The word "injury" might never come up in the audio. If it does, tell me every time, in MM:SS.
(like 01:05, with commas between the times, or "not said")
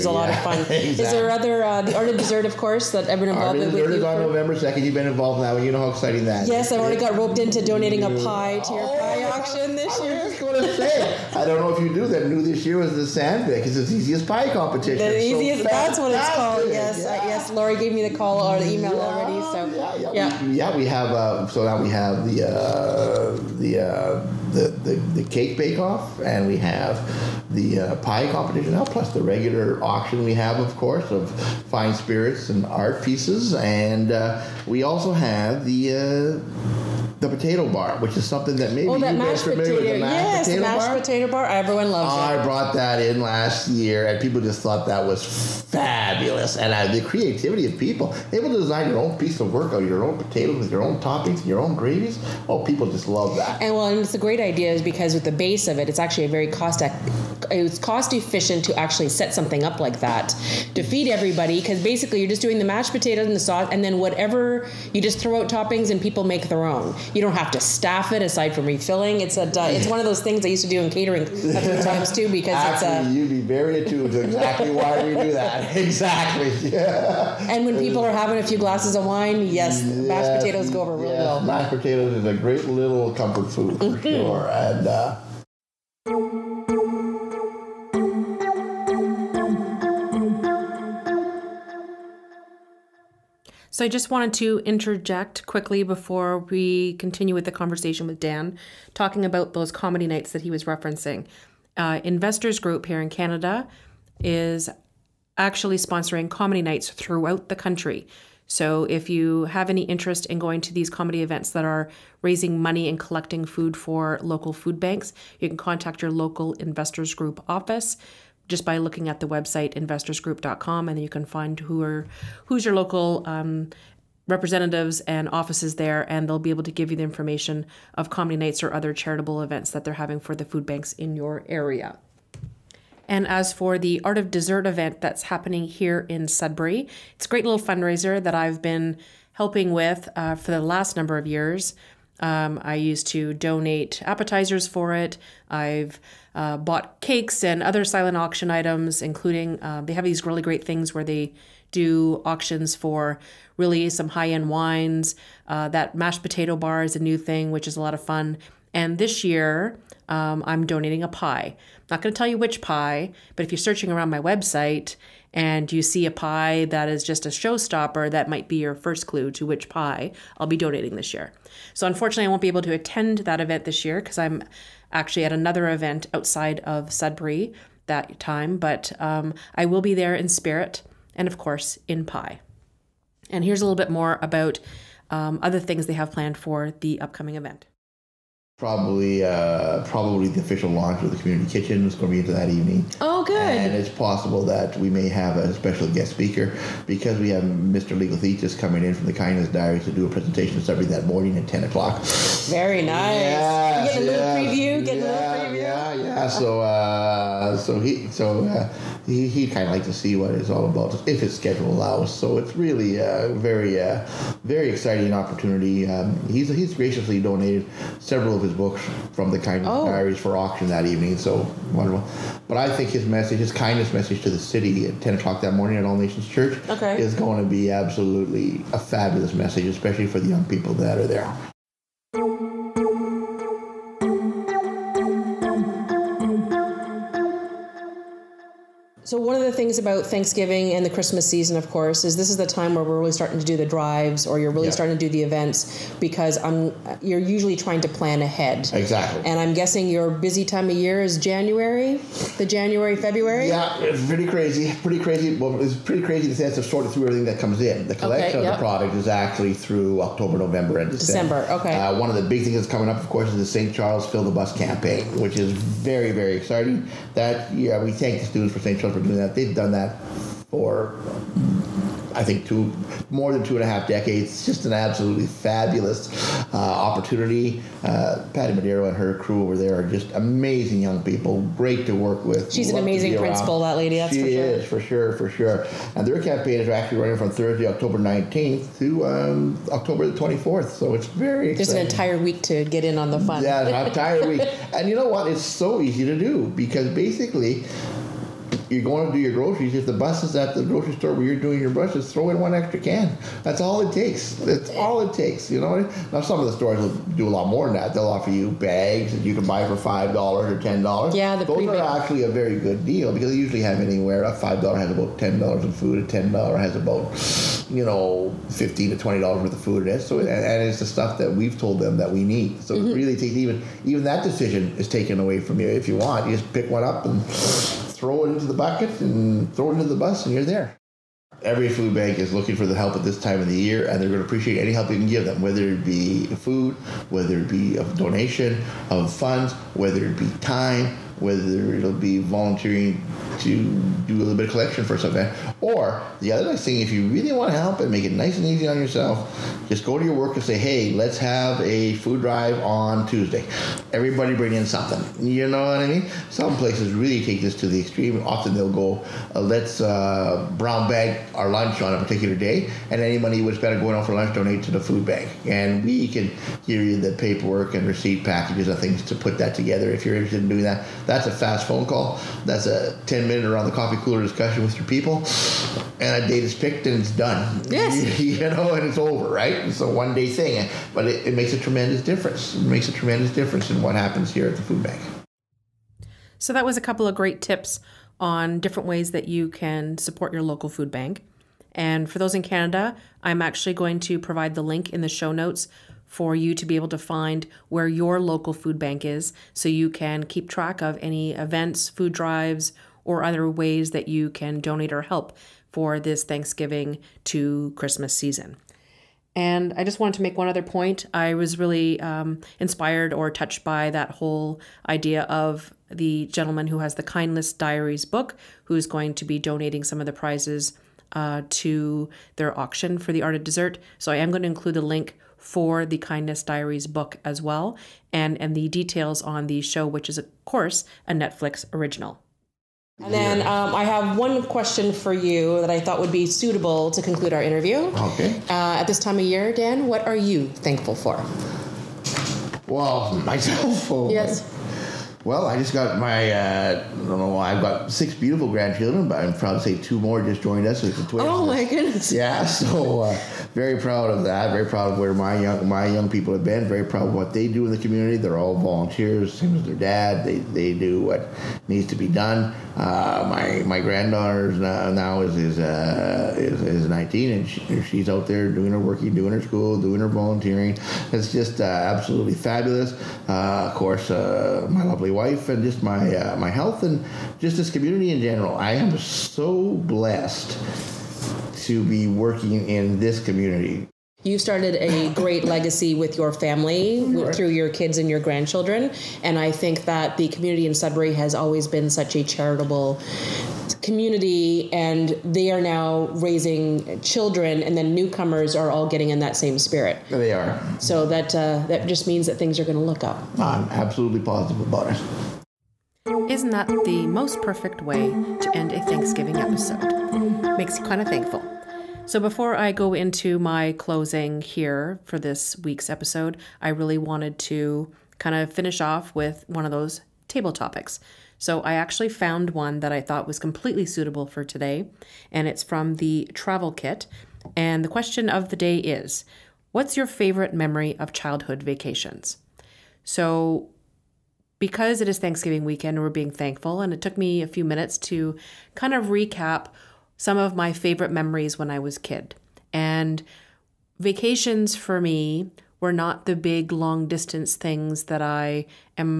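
not said.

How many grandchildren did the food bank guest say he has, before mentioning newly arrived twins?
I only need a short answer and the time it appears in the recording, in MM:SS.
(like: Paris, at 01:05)
6, at 07:27.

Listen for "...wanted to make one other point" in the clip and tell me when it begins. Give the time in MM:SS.
06:49.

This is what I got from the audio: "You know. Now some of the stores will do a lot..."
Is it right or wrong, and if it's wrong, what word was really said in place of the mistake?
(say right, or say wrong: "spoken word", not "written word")
right.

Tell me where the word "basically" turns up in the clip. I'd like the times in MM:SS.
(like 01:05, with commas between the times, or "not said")
01:01, 04:56.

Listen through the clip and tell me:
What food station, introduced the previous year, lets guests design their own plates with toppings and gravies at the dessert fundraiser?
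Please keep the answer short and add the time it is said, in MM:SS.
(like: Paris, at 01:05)
Mashed potato bar, at 00:40.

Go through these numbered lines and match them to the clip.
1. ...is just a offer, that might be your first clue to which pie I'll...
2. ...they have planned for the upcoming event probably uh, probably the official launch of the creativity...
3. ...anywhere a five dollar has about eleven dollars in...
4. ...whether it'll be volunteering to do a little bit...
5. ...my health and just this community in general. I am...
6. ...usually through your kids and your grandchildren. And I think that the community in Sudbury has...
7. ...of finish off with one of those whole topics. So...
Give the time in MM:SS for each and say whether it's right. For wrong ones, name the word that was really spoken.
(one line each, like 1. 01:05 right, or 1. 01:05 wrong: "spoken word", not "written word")
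1. 02:46 wrong: "showstopper", not "offer"
2. 03:05 wrong: "community", not "creativity"
3. 05:13 wrong: "ten", not "eleven"
4. 05:41 right
5. 07:56 right
6. 08:06 wrong: "family", not "usually"
7. 08:38 wrong: "table", not "whole".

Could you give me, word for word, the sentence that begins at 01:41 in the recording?
Uh, investors Group here in Canada is actually sponsoring comedy nights throughout the country.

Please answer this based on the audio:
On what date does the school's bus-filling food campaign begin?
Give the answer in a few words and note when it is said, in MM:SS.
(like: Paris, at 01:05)
October 19, at 04:47.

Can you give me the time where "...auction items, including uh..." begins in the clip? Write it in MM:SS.
02:28.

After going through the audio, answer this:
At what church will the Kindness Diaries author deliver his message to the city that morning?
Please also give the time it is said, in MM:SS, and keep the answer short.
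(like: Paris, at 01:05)
All Nations Church, at 03:45.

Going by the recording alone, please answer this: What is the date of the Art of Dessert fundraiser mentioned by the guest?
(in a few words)
November 2.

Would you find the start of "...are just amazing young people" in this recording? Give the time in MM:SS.
04:39.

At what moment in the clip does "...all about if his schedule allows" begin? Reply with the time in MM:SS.
03:30.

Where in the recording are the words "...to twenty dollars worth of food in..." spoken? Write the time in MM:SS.
05:18.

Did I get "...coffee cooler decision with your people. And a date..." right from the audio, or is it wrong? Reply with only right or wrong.
wrong.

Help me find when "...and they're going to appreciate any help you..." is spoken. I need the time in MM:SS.
05:33.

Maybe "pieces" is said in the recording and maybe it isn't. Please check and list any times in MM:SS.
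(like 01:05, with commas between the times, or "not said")
00:33, 00:49.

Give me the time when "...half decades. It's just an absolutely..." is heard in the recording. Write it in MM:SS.
04:33.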